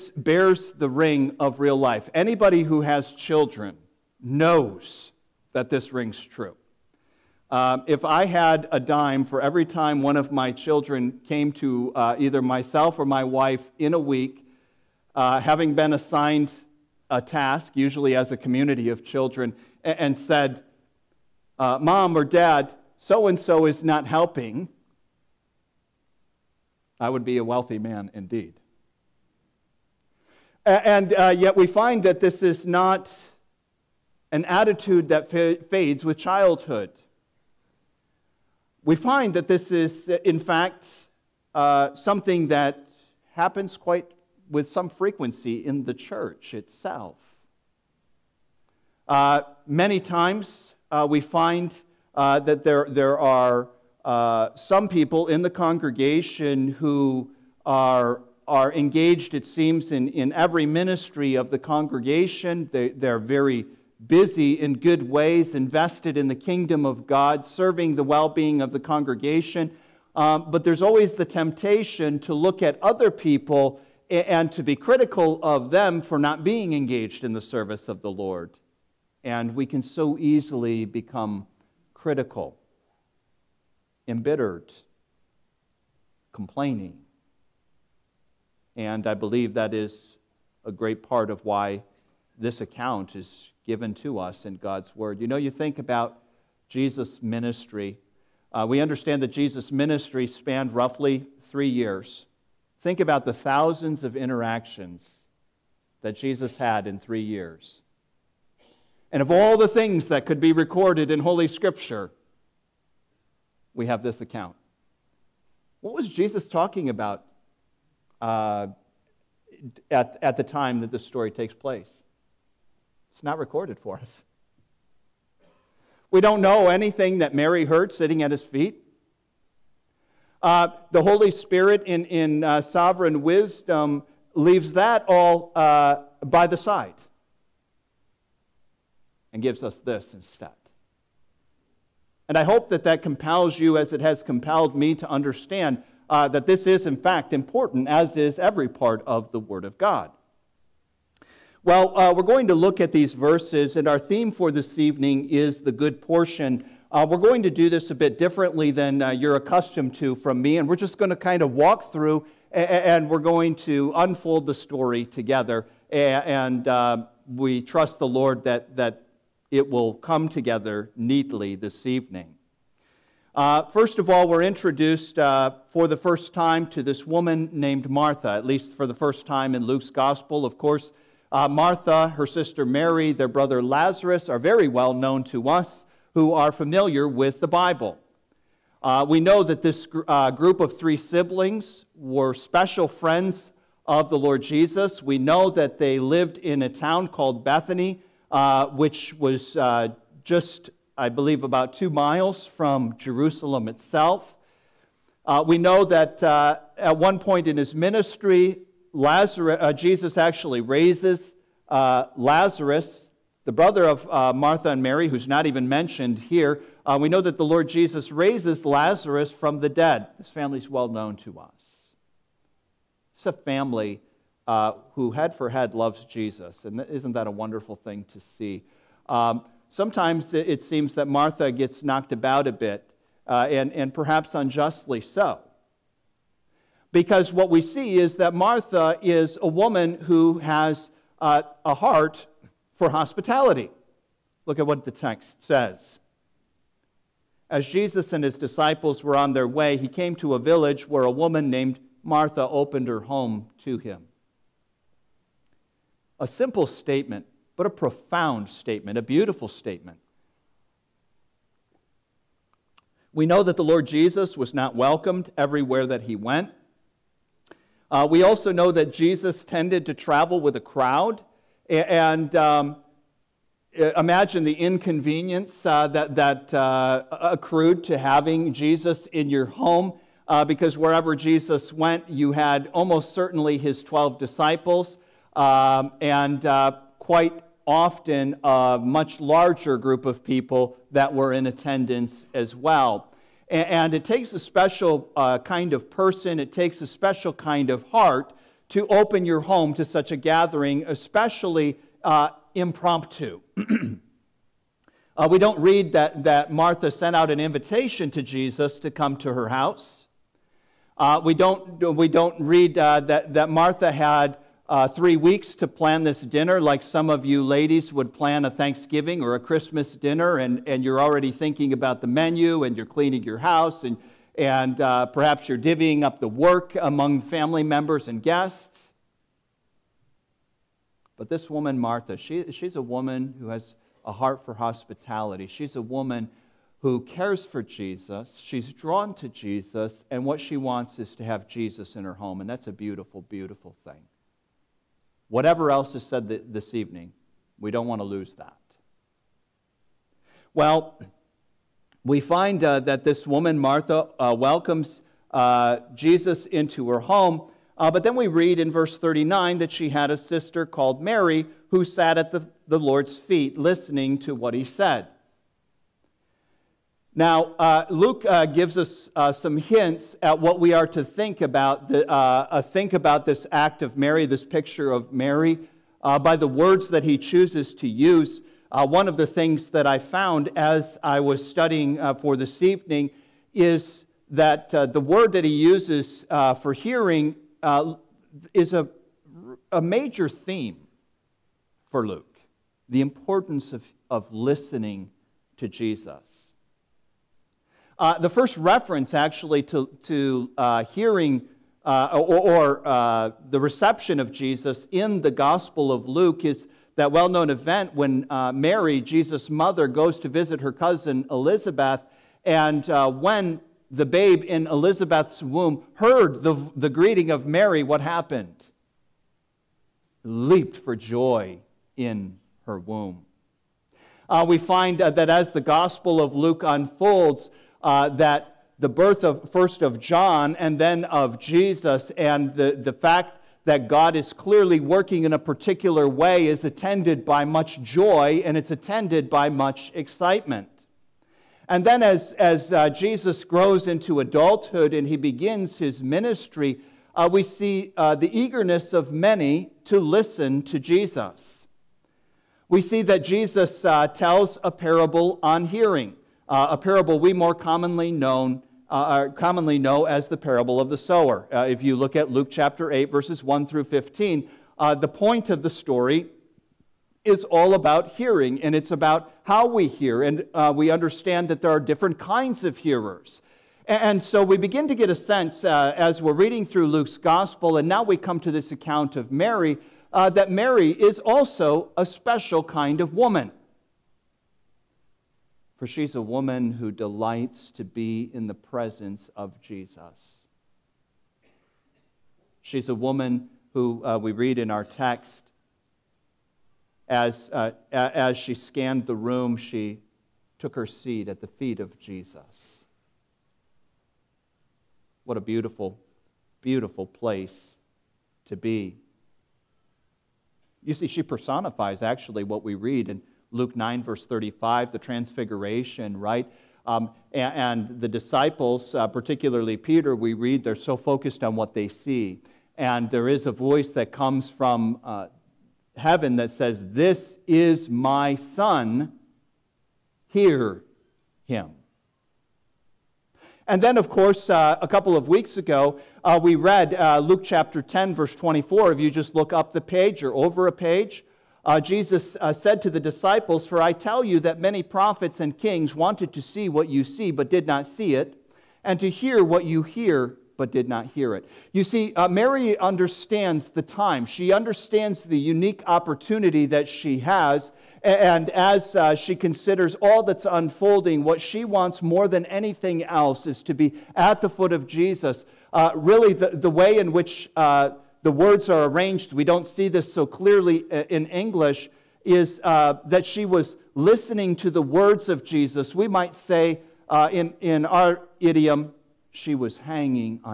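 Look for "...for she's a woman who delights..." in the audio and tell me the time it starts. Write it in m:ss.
8:05.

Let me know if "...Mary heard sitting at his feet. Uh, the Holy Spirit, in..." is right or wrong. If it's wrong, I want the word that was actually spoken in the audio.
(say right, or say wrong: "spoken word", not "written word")
right.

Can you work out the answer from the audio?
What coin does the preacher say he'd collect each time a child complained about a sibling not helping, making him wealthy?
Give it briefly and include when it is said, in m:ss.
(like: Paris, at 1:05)
dime, at 0:08.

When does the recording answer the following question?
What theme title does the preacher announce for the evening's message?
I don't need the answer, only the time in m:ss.
2:35.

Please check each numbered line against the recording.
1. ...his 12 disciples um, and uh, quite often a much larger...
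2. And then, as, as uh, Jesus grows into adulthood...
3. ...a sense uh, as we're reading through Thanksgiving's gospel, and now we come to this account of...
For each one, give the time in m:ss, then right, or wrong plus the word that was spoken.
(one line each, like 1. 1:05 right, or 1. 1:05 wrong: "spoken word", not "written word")
1. 4:43 right
2. 7:21 right
3. 7:55 wrong: "Luke", not "Thanksgiving".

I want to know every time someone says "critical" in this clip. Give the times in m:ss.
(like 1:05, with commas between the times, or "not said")
1:14, 1:21.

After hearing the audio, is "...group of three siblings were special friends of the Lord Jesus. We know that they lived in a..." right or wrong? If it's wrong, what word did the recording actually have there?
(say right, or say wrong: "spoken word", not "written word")
right.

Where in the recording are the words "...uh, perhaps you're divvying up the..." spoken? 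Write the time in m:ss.
5:24.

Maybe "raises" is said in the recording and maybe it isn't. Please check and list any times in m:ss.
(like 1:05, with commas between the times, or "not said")
3:30, 3:38.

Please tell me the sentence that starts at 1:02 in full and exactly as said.
They, they're very busy in good ways, invested in the kingdom of God, serving the well being of the congregation.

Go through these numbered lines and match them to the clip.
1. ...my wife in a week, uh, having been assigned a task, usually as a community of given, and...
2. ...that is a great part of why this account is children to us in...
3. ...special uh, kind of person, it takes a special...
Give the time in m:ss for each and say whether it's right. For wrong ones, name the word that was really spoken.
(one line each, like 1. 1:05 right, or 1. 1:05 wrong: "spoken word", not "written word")
1. 0:13 wrong: "children", not "given"
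2. 1:29 wrong: "given", not "children"
3. 4:54 right.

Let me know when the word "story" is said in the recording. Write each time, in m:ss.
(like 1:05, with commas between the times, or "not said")
2:01, 2:44, 7:45.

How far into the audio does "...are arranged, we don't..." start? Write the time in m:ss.
9:28.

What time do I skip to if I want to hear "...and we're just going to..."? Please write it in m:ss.
2:40.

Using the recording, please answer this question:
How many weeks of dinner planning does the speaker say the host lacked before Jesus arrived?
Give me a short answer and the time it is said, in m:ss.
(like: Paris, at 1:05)
3, at 5:14.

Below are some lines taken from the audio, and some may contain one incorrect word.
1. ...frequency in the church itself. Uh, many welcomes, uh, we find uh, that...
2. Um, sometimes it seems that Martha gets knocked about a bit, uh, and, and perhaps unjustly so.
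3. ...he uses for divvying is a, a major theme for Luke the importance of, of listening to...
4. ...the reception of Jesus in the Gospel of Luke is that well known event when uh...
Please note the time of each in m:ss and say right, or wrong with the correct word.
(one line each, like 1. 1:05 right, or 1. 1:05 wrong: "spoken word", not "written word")
1. 0:44 wrong: "times", not "welcomes"
2. 3:49 right
3. 6:25 wrong: "hearing", not "divvying"
4. 6:43 right.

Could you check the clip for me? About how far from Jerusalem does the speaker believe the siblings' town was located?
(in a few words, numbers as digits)
2 miles.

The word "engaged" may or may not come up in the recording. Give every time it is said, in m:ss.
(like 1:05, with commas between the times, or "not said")
0:58, 1:16.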